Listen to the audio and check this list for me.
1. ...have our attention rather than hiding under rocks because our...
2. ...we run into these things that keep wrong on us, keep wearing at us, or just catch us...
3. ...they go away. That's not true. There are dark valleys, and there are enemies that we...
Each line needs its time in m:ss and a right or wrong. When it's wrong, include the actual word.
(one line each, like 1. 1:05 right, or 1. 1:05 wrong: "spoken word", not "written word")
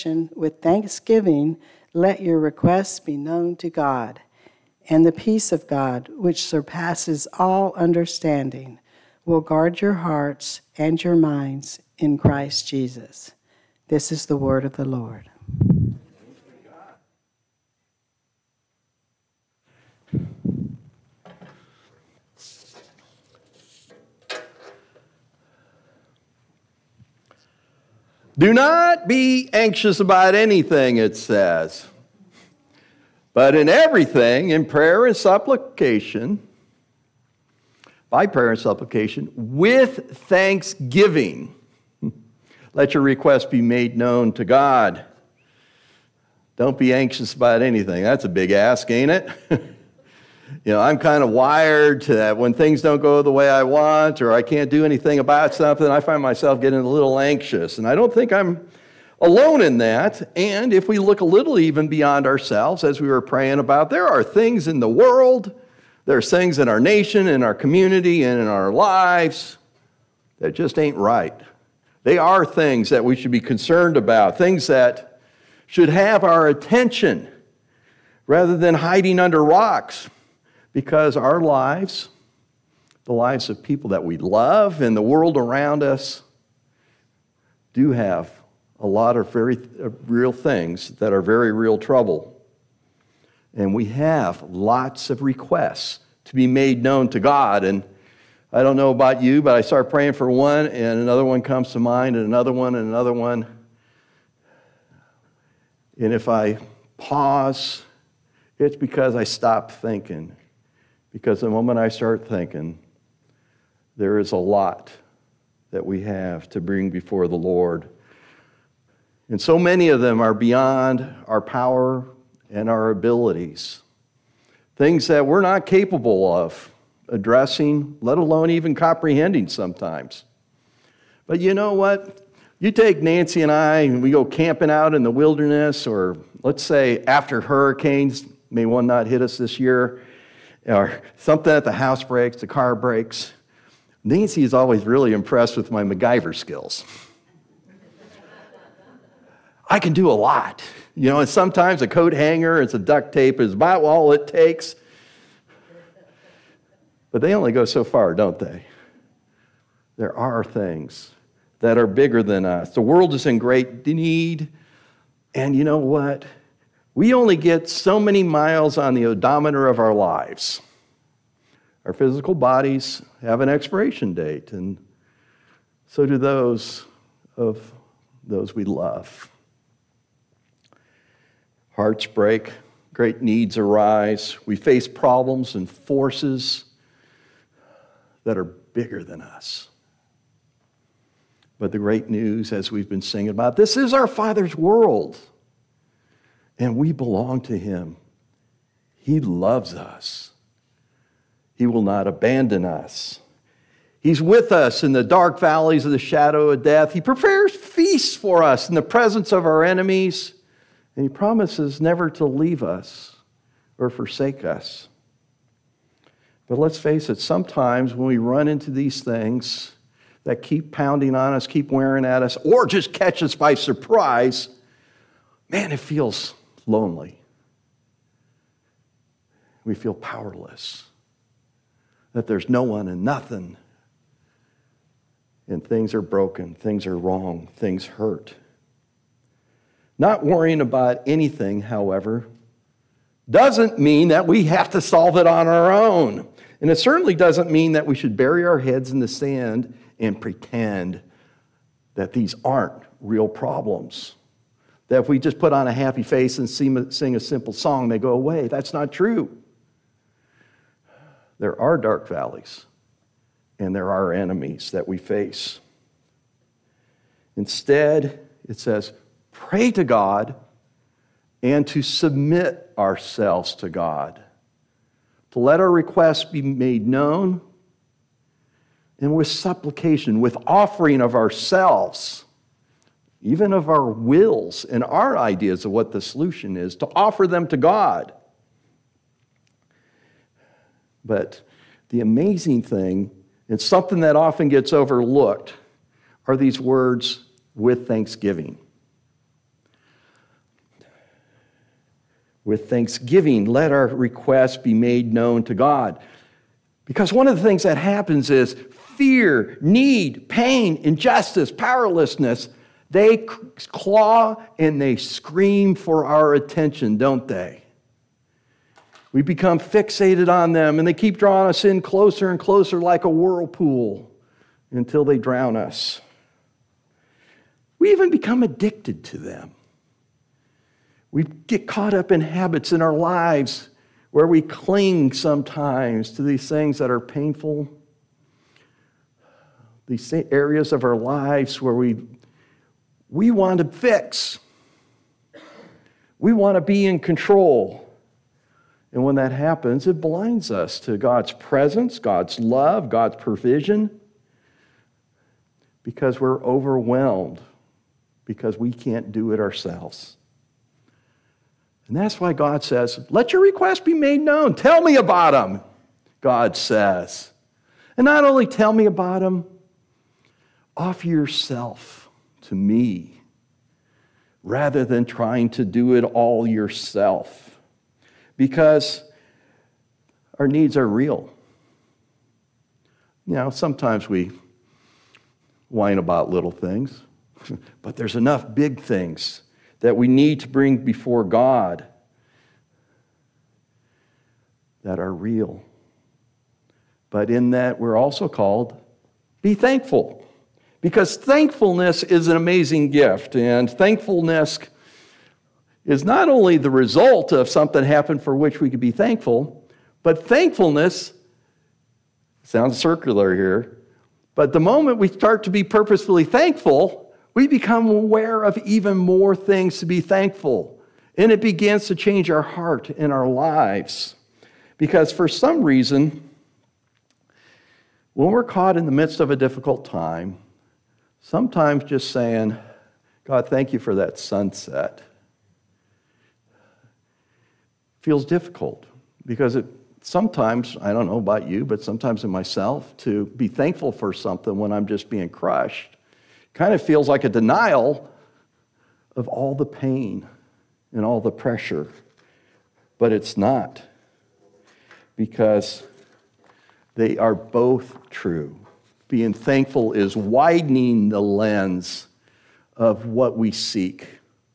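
1. 1:15 right
2. 3:38 wrong: "pounding", not "wrong"
3. 4:17 right.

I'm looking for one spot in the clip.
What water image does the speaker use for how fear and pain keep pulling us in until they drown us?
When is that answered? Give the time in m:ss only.
5:23.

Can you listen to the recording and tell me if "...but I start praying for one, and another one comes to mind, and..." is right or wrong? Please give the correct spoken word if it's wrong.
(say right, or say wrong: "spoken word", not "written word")
right.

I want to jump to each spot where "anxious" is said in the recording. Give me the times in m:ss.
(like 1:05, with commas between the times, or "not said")
0:29, 0:46, 0:57.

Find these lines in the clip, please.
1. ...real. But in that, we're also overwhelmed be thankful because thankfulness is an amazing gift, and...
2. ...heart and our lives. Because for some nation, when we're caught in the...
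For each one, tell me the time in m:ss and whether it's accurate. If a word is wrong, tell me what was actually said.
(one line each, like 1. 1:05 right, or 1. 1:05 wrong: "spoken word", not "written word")
1. 6:35 wrong: "called", not "overwhelmed"
2. 7:02 wrong: "reason", not "nation".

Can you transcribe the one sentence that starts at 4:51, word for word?
But the amazing thing, and something that often gets overlooked, are these words with thanksgiving.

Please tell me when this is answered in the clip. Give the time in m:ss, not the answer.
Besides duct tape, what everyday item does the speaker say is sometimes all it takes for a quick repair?
2:31.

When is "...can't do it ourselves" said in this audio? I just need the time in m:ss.
5:58.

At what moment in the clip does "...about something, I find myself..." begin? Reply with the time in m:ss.
0:55.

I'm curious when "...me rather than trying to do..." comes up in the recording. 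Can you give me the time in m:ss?
6:12.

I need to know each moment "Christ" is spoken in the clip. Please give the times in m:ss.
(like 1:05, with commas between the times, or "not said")
0:12.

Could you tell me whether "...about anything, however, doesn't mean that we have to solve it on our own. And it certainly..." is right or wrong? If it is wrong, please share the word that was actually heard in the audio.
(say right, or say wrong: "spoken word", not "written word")
right.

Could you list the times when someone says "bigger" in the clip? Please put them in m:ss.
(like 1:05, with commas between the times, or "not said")
2:41, 3:08.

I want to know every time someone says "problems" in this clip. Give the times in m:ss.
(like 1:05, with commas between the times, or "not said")
3:04, 4:13.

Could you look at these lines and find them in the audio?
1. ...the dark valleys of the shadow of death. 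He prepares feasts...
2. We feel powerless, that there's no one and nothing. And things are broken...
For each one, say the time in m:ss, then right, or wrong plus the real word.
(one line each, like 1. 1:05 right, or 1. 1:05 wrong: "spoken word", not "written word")
1. 3:24 right
2. 3:49 right.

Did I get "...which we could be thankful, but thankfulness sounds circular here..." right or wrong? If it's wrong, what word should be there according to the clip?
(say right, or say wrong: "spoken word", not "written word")
right.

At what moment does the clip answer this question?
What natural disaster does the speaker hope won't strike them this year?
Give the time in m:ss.
2:17.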